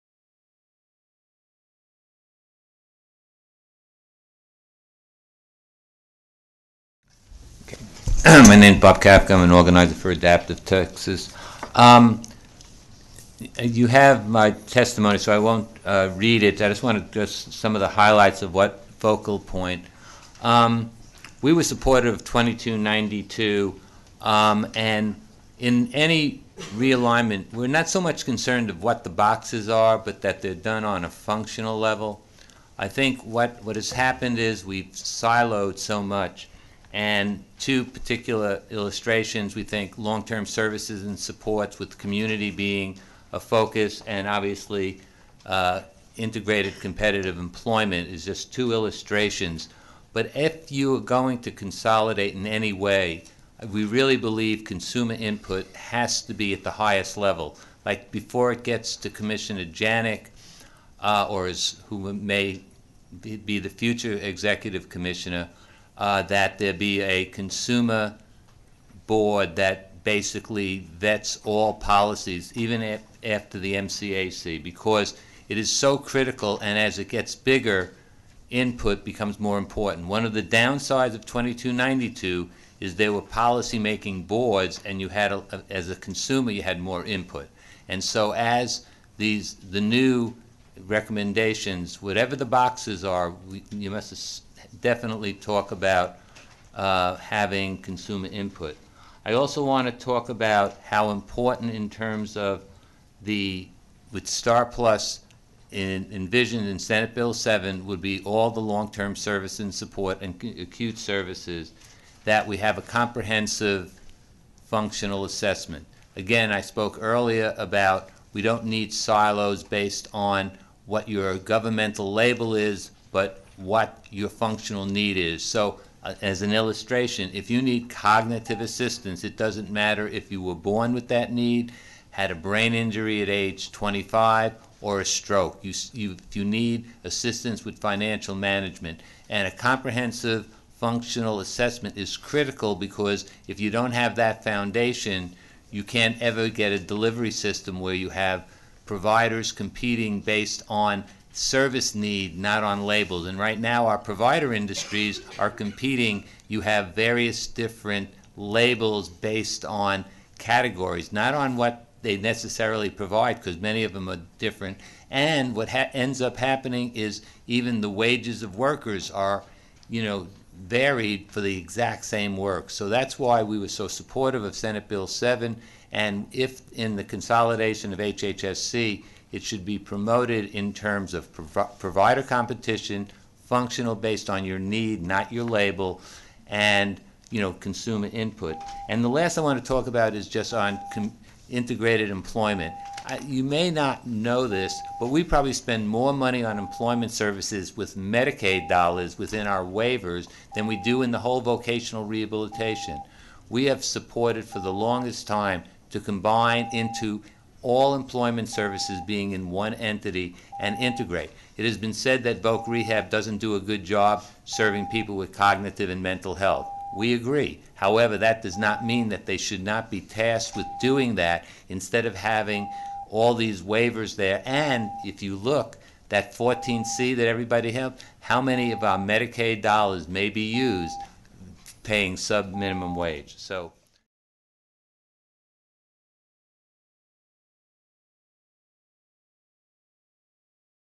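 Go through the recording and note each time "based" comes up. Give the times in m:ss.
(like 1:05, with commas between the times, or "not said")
1:59, 2:30, 2:39, 3:03.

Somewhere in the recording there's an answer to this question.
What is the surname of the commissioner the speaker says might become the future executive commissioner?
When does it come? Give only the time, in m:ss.
0:59.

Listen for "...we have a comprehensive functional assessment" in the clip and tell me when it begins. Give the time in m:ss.
1:52.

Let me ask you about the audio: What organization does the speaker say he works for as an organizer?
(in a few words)
Adaptive Texas.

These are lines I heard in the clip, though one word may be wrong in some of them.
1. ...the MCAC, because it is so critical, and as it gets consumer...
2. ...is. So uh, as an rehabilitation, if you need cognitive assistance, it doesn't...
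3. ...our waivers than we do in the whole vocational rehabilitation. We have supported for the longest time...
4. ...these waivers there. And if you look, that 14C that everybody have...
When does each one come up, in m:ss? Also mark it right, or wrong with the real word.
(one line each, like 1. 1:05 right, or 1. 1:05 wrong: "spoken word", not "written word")
1. 1:13 wrong: "bigger", not "consumer"
2. 2:05 wrong: "illustration", not "rehabilitation"
3. 3:19 right
4. 3:43 right.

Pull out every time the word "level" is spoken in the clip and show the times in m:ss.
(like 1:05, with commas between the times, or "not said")
0:31, 0:57.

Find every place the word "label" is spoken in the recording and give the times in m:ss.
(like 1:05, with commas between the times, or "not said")
2:02, 2:32, 2:38, 3:05.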